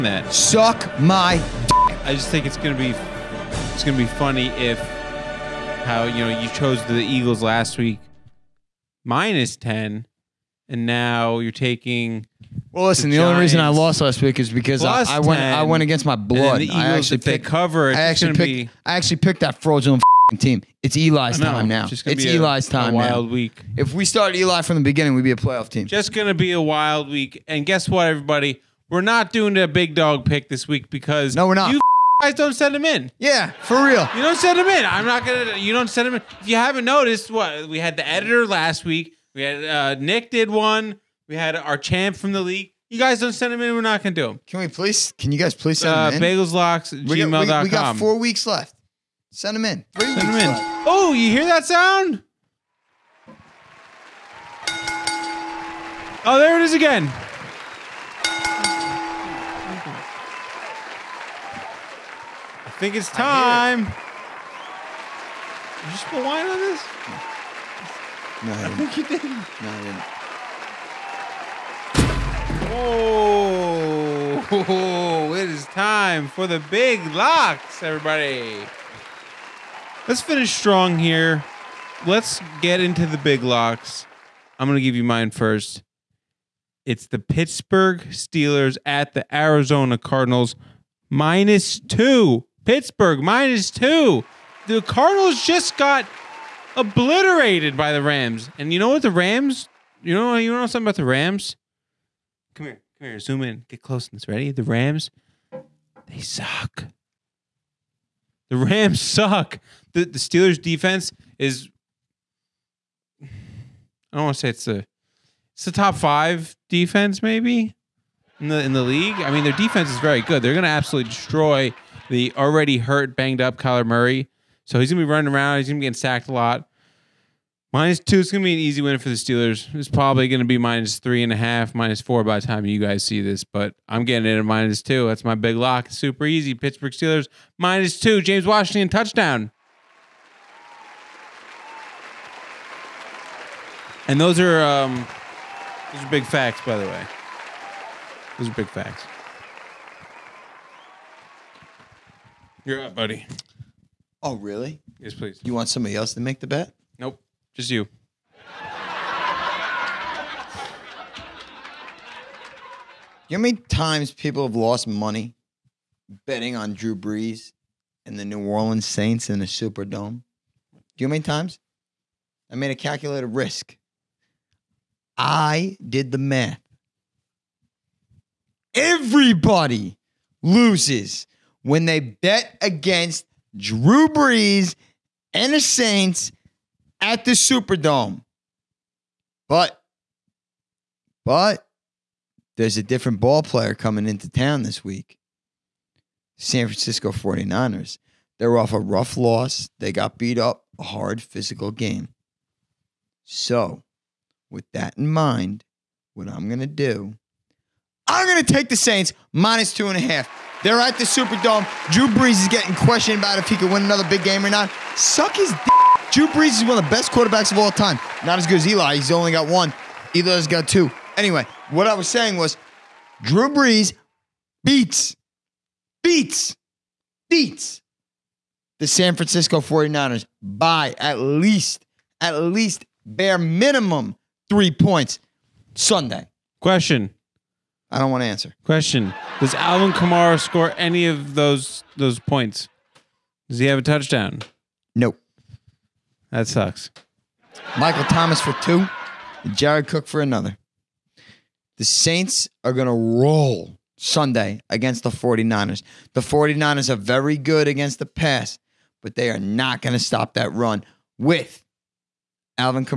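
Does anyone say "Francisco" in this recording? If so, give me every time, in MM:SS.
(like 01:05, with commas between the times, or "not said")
03:16, 03:49.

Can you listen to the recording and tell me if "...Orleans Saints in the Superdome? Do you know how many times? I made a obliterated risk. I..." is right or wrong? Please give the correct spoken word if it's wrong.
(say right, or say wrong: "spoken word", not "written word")
wrong: "calculated", not "obliterated".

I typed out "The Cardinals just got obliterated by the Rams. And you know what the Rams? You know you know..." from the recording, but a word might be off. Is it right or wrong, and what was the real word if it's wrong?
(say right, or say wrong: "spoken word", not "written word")
right.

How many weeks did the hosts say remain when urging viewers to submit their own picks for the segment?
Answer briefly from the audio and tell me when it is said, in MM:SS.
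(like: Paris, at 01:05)
4, at 00:47.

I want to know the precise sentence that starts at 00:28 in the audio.
We're not doing a big dog pick this week because no, we're not.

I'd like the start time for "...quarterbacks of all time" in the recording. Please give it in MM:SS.
03:37.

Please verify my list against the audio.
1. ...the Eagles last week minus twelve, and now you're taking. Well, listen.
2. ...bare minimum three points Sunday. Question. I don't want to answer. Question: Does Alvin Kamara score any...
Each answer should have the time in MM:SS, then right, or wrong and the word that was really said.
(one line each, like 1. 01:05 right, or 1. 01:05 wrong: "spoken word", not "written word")
1. 00:06 wrong: "ten", not "twelve"
2. 03:53 right.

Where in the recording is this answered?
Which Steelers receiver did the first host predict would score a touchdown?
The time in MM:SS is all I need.
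02:18.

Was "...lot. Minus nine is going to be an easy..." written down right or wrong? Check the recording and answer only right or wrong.
wrong.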